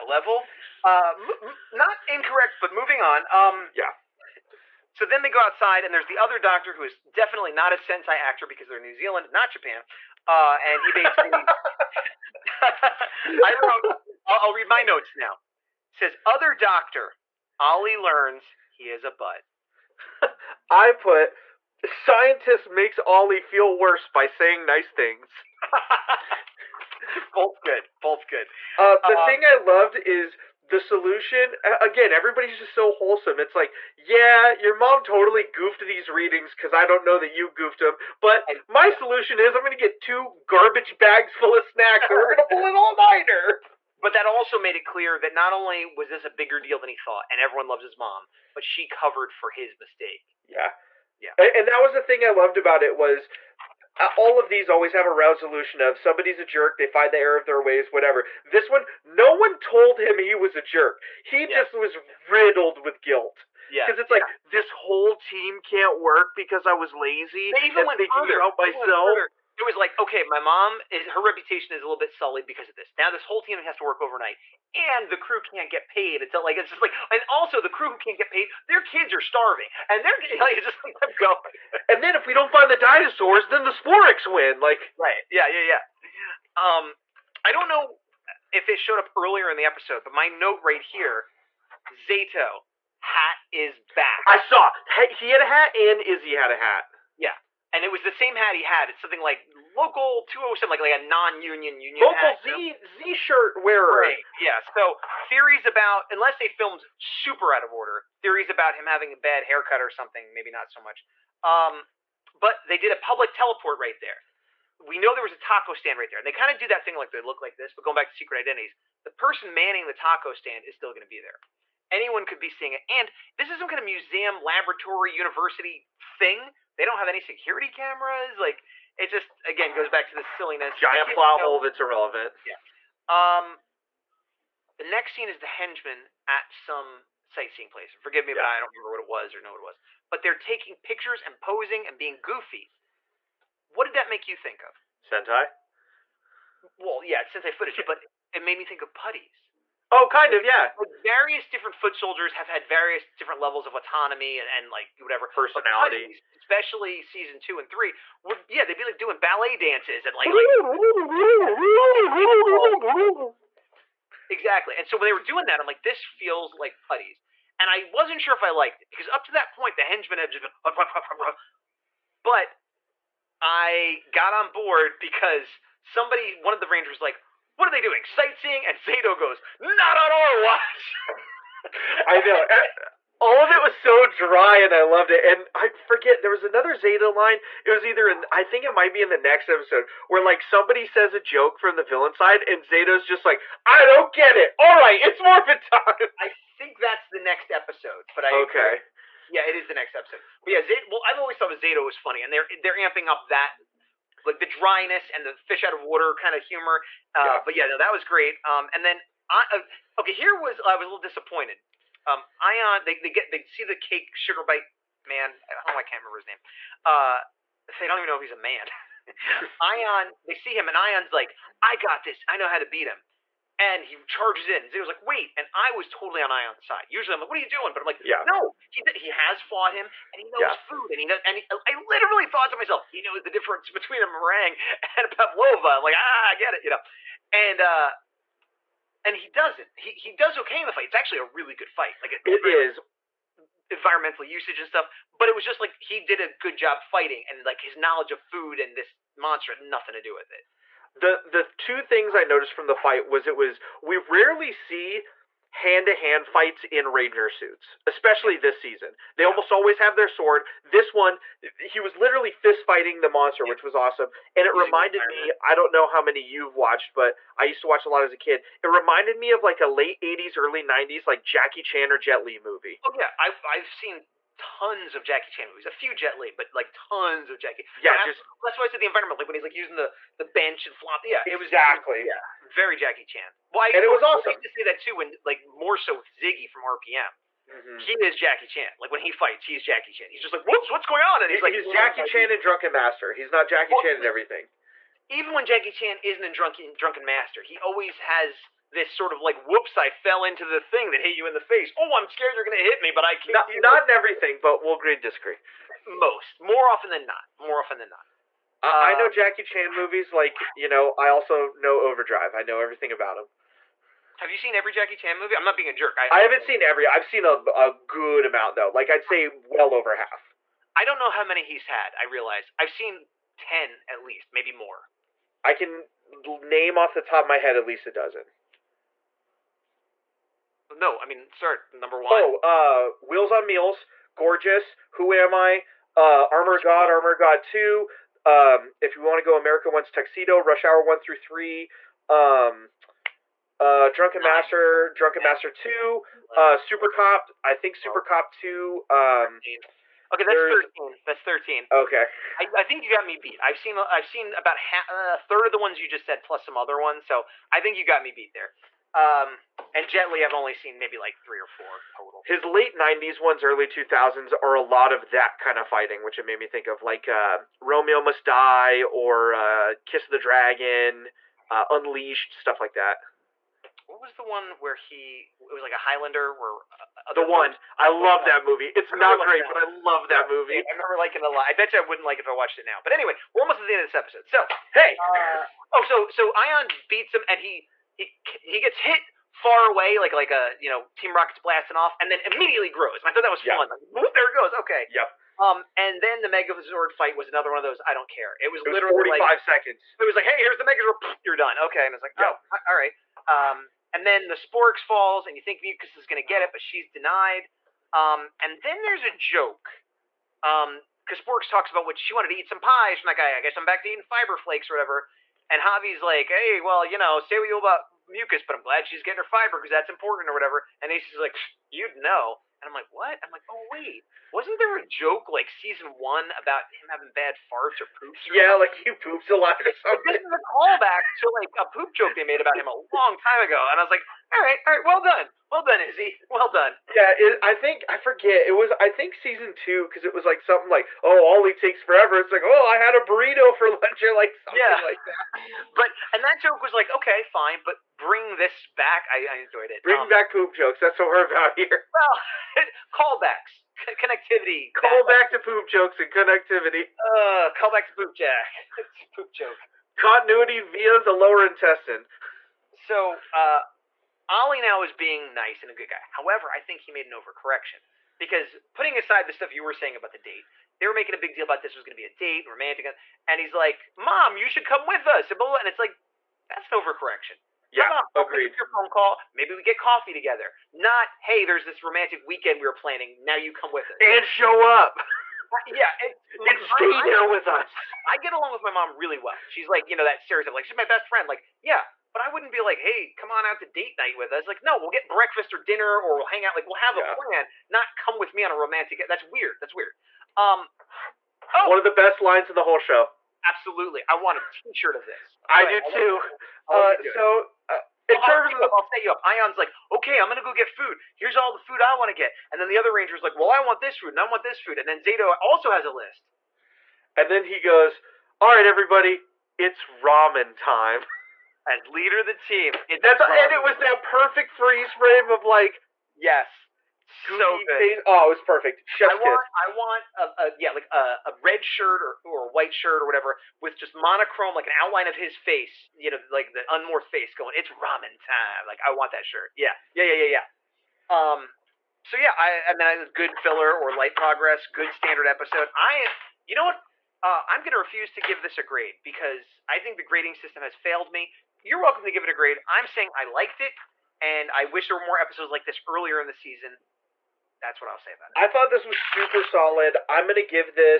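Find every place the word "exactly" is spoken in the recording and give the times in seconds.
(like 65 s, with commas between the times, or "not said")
164 s, 281 s.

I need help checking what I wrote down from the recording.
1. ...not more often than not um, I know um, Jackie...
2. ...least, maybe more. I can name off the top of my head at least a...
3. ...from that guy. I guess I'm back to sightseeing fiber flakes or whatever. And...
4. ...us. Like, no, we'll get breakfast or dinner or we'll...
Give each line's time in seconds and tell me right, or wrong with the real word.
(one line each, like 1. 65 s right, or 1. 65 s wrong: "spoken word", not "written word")
1. 307 s right
2. 324 s right
3. 413 s wrong: "eating", not "sightseeing"
4. 494 s right.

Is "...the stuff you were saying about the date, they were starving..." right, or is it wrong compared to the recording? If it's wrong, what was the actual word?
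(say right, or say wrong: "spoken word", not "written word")
wrong: "making", not "starving".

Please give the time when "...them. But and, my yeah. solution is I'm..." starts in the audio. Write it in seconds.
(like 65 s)
37 s.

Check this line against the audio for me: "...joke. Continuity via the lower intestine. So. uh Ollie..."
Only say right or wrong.
right.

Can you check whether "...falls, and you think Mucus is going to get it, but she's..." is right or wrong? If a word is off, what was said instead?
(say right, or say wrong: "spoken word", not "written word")
right.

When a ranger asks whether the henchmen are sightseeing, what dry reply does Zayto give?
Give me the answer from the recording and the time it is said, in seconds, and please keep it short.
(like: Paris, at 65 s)
Not on our watch, at 179 s.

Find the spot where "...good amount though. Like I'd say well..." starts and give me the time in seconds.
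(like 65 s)
317 s.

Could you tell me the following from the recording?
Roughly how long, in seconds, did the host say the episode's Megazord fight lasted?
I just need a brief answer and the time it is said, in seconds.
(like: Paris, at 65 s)
45, at 398 s.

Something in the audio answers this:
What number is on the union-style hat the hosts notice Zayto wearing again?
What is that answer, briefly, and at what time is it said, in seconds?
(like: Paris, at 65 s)
207, at 100 s.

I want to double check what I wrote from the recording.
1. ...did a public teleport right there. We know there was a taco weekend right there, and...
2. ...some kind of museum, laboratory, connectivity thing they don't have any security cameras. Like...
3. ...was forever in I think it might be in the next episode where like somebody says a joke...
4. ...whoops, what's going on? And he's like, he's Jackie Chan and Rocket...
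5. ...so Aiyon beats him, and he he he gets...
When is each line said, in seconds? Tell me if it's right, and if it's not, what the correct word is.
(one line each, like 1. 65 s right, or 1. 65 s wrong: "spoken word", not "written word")
1. 112 s wrong: "stand", not "weekend"
2. 123 s wrong: "university", not "connectivity"
3. 187 s wrong: "either", not "forever"
4. 290 s wrong: "Drunken", not "Rocket"
5. 386 s right.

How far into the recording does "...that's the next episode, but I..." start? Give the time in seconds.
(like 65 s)
196 s.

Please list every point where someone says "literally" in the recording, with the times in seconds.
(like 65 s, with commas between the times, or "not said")
231 s, 261 s, 398 s.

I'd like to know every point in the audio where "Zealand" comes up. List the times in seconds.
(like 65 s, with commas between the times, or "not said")
8 s.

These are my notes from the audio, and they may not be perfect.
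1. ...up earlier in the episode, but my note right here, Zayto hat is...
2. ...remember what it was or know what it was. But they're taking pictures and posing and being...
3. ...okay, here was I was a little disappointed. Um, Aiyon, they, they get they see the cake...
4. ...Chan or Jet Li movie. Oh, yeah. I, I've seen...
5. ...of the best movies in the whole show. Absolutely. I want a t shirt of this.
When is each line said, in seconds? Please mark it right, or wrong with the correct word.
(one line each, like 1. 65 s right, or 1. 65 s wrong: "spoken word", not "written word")
1. 88 s right
2. 138 s right
3. 210 s right
4. 271 s right
5. 501 s wrong: "lines", not "movies".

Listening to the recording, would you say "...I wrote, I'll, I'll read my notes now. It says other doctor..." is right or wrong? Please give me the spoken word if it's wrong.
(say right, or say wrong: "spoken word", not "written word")
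right.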